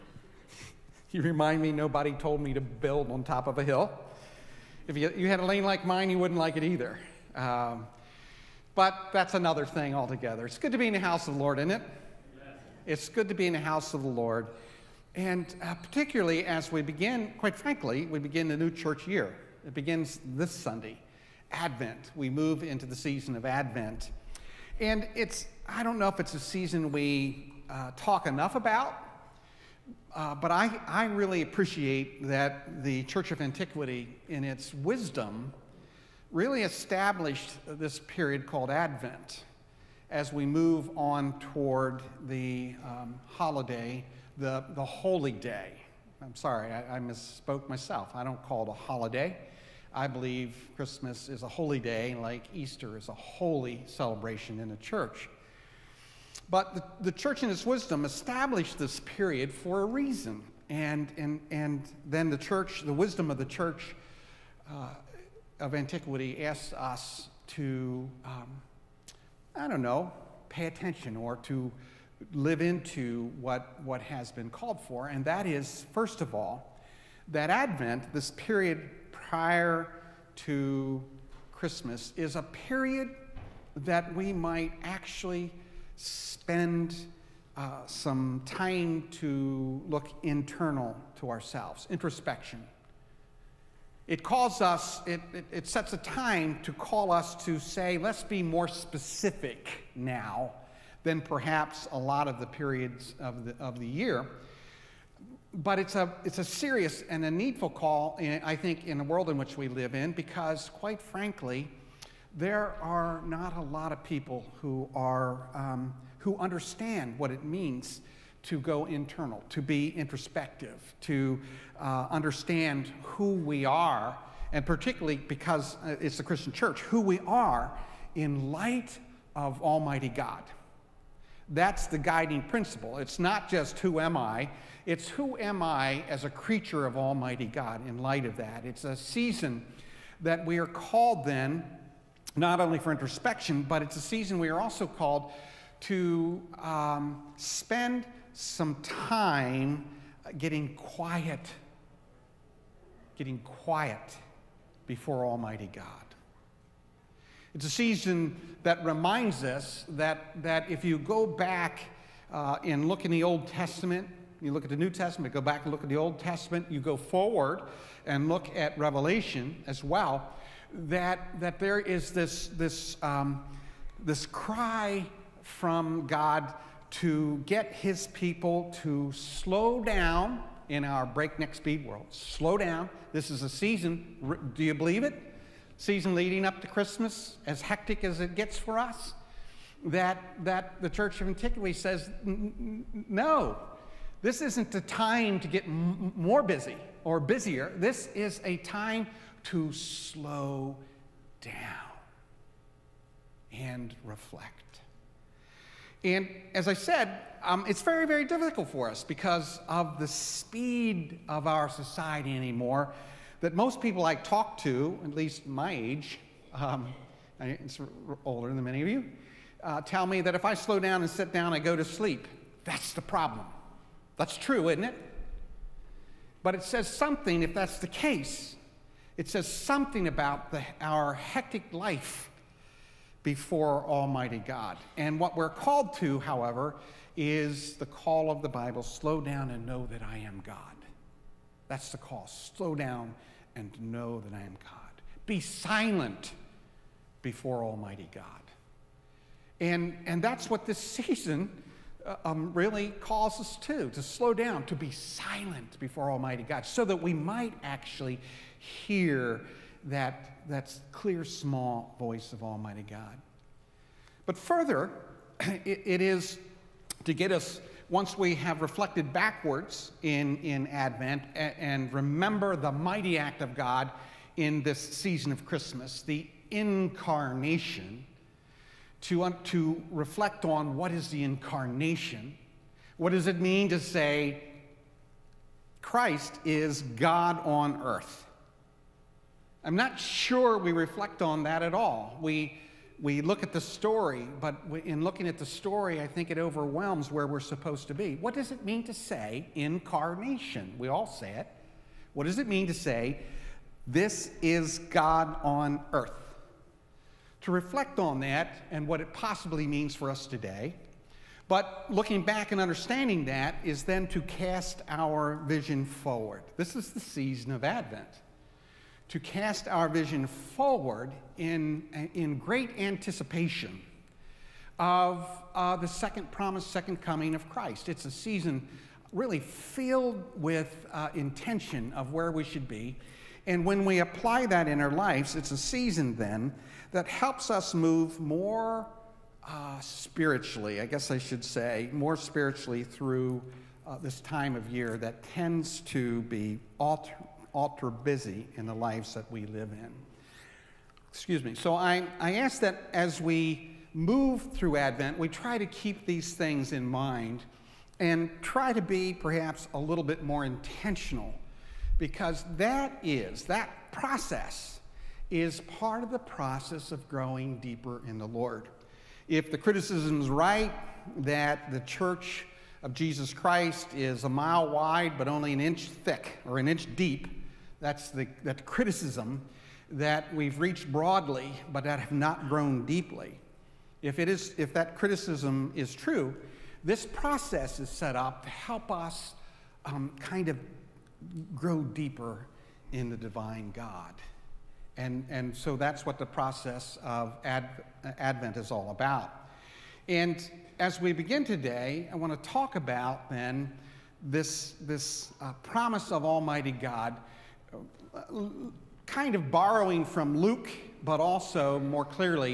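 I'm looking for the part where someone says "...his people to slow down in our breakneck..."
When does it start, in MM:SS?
02:57.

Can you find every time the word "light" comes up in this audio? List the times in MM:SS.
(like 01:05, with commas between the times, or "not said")
02:08, 02:17.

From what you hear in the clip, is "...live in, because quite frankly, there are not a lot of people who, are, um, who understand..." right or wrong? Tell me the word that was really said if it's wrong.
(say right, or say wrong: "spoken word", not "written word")
right.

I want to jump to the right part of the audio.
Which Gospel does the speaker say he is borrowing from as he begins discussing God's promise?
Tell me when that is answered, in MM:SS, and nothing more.
06:50.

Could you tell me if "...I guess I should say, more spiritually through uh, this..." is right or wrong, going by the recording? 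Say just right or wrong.
right.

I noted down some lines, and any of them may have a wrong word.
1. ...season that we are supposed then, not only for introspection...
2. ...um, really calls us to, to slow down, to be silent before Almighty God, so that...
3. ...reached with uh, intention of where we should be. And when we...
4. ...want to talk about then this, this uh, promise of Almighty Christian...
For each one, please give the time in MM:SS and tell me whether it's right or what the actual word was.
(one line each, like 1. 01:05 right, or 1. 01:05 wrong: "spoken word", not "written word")
1. 02:18 wrong: "called", not "supposed"
2. 04:12 right
3. 05:29 wrong: "filled", not "reached"
4. 06:42 wrong: "God", not "Christian".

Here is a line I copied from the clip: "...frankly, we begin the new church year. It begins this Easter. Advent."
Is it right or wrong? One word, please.
wrong.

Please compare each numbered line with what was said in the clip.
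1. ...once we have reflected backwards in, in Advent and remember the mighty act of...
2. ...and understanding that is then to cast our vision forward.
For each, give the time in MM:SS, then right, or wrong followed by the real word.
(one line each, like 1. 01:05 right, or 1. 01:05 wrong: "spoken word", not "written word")
1. 04:27 right
2. 05:12 right.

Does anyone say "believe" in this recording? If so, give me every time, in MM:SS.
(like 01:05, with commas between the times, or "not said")
00:50, 03:04.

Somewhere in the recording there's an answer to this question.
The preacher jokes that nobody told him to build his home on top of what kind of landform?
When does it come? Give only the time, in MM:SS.
00:03.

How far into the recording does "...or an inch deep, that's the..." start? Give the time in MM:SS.
06:16.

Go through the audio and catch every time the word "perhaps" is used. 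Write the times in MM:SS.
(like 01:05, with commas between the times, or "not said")
01:41, 05:59.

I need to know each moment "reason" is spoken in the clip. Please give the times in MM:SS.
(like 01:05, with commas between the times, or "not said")
00:59.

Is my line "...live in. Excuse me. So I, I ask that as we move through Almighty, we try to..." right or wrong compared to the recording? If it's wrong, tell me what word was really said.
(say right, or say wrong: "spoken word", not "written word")
wrong: "Advent", not "Almighty".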